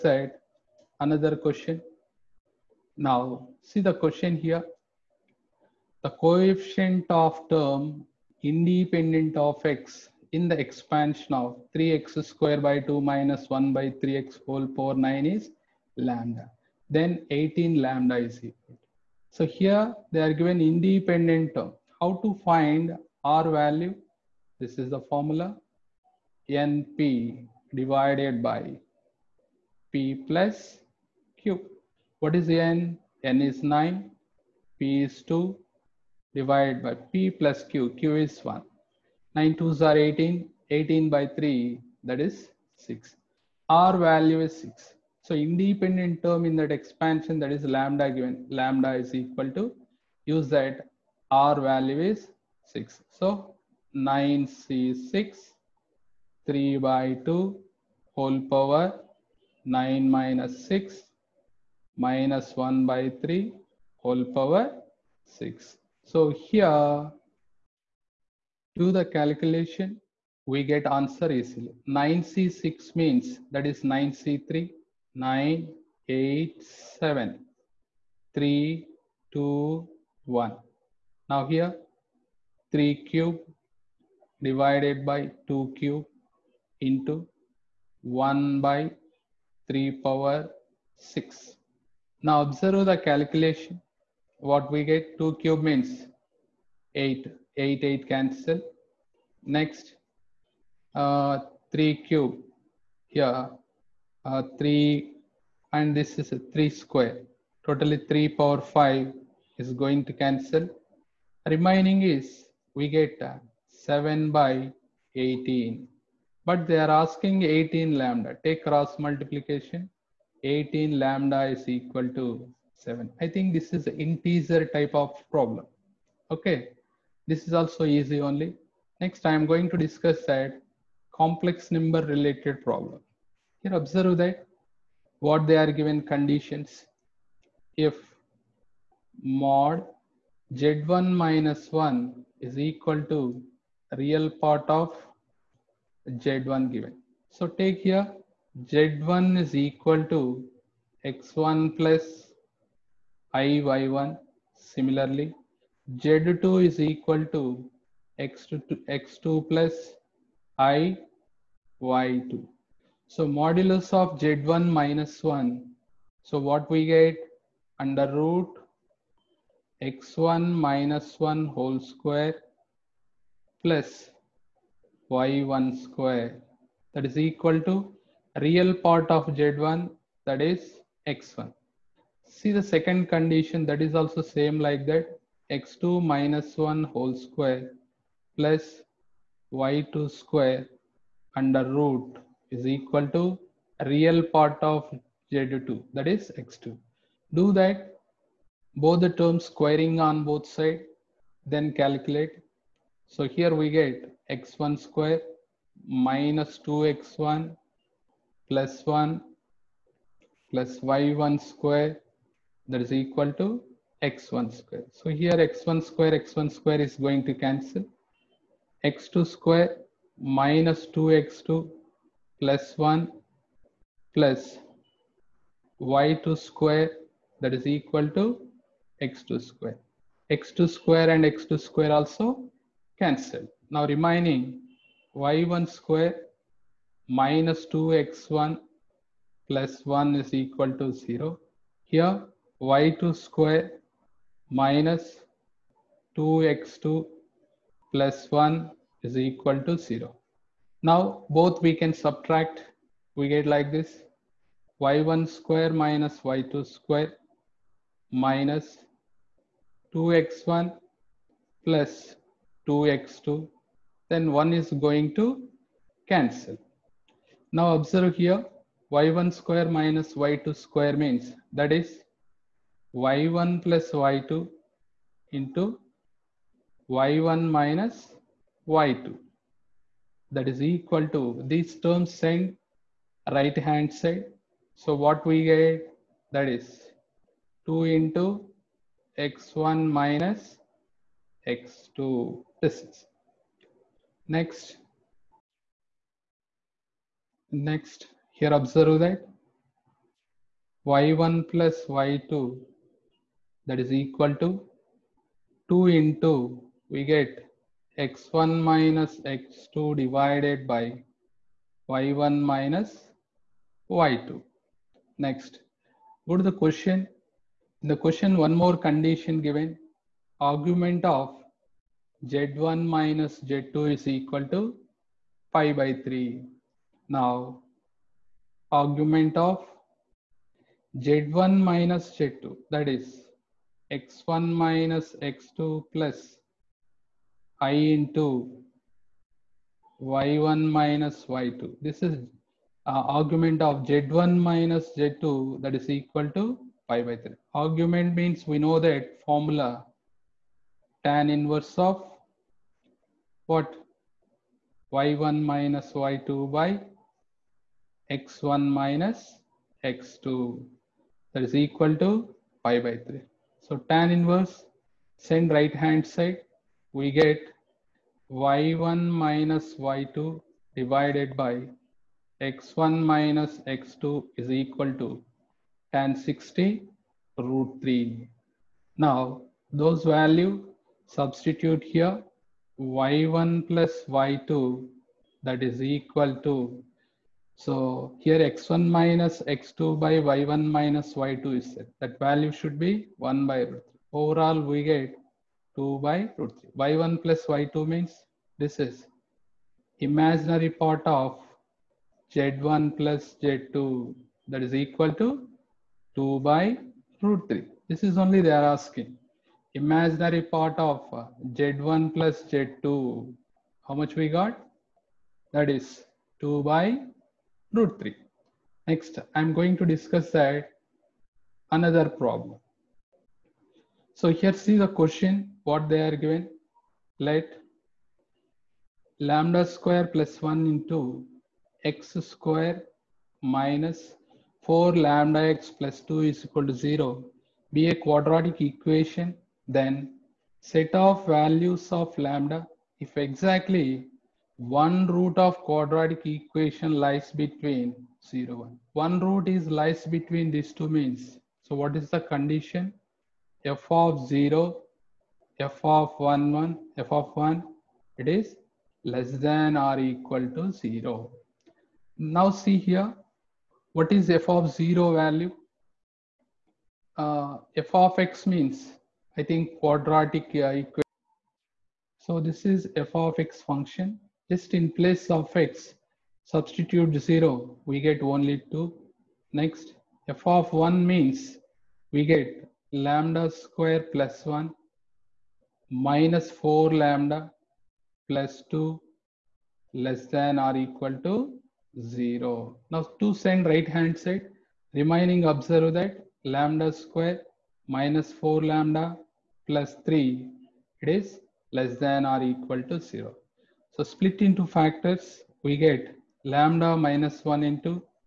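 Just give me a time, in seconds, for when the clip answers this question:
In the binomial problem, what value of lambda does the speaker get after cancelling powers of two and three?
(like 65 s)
113 s.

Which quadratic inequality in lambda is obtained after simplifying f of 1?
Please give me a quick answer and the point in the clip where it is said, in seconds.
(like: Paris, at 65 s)
lambda square minus 4 lambda plus 3, at 496 s.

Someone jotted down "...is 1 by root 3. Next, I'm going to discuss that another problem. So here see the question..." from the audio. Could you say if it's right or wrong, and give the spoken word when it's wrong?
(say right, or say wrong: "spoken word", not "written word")
wrong: "2", not "1".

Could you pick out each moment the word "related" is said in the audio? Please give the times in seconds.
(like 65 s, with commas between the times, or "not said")
132 s.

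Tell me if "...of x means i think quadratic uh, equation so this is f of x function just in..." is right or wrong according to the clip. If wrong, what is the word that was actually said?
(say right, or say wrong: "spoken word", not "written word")
right.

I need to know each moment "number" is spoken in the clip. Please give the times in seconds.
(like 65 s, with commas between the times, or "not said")
131 s.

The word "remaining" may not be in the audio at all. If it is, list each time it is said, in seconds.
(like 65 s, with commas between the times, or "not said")
111 s, 233 s, 494 s.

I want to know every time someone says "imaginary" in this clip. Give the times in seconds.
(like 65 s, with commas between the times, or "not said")
399 s, 409 s.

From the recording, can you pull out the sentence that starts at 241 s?
Here y2 square minus 2x2 plus 1 is equal to 0.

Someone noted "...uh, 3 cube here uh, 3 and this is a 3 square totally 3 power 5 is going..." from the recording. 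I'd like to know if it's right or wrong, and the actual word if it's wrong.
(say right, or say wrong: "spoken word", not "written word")
right.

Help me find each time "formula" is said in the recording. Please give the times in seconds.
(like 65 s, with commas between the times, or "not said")
25 s, 349 s.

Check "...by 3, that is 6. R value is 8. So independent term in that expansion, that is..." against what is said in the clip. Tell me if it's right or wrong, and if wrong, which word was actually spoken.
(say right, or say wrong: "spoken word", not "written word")
wrong: "6", not "8".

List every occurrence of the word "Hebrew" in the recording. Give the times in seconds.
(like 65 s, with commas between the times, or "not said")
not said.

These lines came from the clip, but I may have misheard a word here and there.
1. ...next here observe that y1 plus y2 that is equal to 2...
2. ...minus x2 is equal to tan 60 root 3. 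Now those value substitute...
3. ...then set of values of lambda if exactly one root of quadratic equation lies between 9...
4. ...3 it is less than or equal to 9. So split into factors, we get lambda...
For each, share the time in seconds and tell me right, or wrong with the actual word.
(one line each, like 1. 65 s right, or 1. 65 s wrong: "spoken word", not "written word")
1. 297 s right
2. 373 s right
3. 439 s wrong: "0", not "9"
4. 500 s wrong: "0", not "9".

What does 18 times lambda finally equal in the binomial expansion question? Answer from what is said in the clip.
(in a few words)
7.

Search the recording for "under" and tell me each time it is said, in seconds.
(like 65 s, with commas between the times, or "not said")
167 s, 191 s.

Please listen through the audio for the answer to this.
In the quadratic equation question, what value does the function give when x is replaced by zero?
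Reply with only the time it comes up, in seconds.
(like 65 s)
477 s.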